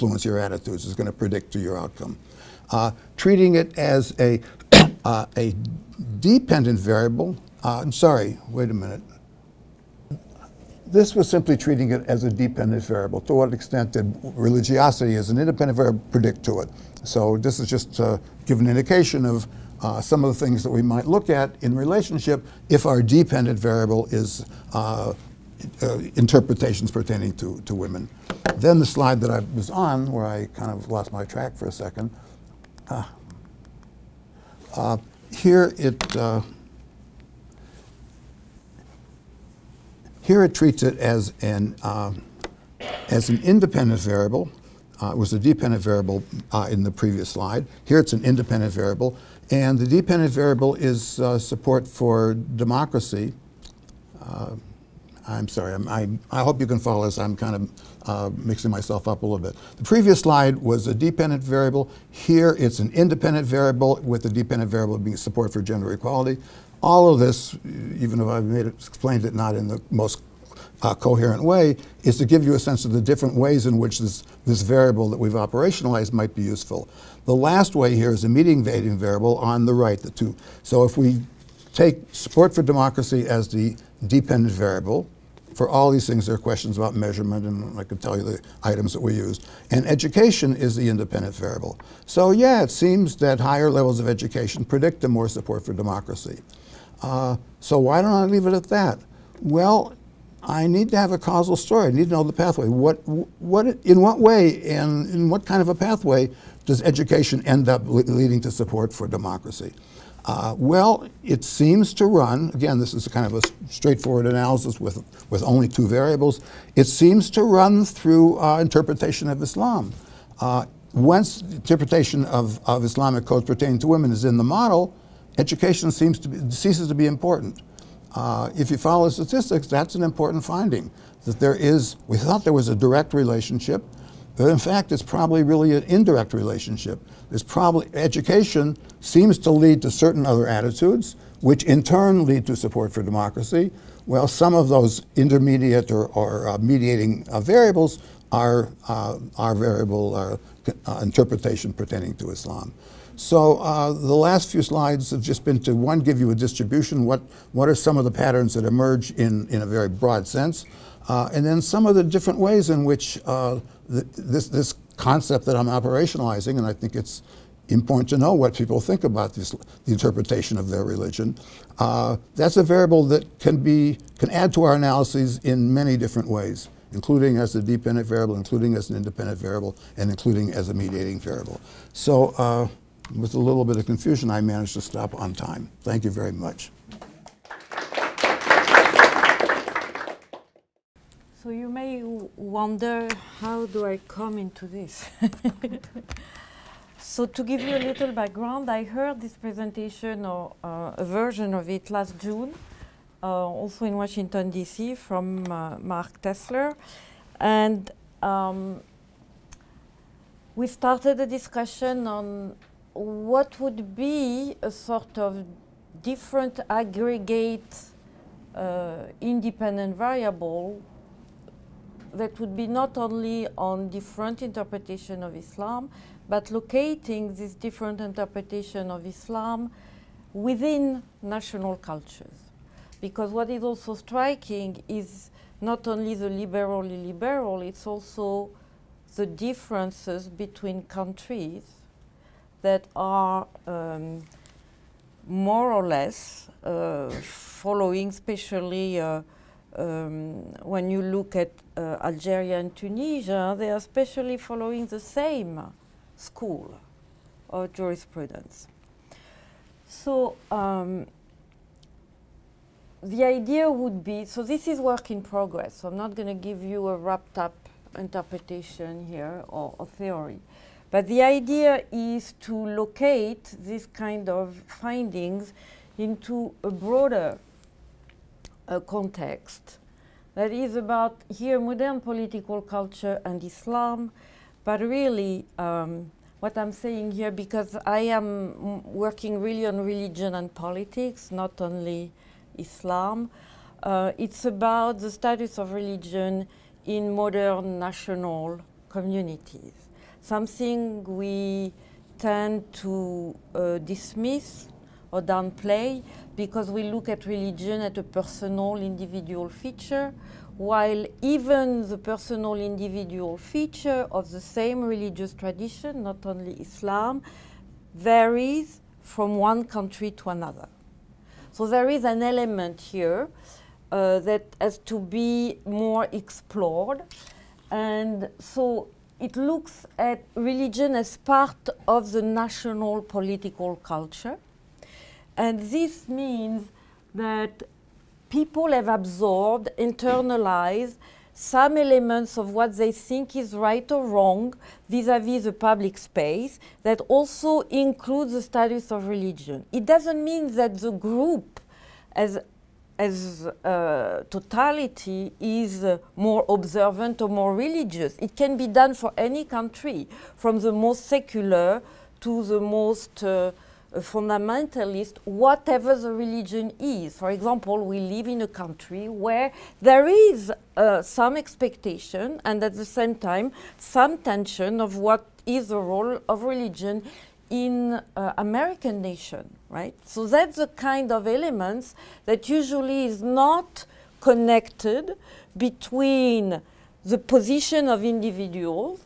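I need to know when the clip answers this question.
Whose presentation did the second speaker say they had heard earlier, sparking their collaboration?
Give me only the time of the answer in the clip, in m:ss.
3:25.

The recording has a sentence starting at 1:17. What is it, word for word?
The last way here is a mediating variable on the right, the two.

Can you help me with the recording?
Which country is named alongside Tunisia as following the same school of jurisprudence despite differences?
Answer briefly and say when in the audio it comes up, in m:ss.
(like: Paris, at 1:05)
Algeria, at 4:12.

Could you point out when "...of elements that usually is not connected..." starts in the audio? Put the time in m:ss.
6:21.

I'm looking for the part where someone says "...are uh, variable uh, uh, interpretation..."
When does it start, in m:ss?
2:28.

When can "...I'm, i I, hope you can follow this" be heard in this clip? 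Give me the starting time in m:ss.
0:55.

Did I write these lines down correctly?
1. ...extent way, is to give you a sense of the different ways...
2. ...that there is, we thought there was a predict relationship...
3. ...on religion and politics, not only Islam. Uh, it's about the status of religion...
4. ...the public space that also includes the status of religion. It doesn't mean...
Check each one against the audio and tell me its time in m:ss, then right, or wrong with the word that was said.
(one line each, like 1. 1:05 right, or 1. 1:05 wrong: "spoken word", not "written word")
1. 1:10 wrong: "coherent", not "extent"
2. 2:11 wrong: "direct", not "predict"
3. 4:49 right
4. 5:45 right.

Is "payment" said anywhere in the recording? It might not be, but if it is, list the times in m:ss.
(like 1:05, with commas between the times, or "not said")
not said.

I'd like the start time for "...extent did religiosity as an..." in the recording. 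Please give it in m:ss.
0:13.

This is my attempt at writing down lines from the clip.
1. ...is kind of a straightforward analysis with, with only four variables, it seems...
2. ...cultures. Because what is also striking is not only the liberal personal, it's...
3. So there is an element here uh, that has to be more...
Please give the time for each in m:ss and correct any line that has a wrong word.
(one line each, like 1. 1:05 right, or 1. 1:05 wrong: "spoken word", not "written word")
1. 1:52 wrong: "two", not "four"
2. 3:51 wrong: "liberal", not "personal"
3. 5:21 right.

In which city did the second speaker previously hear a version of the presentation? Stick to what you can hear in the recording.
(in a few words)
Washington D.C.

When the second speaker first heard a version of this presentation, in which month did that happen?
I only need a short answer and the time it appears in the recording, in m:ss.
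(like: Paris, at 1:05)
June, at 3:21.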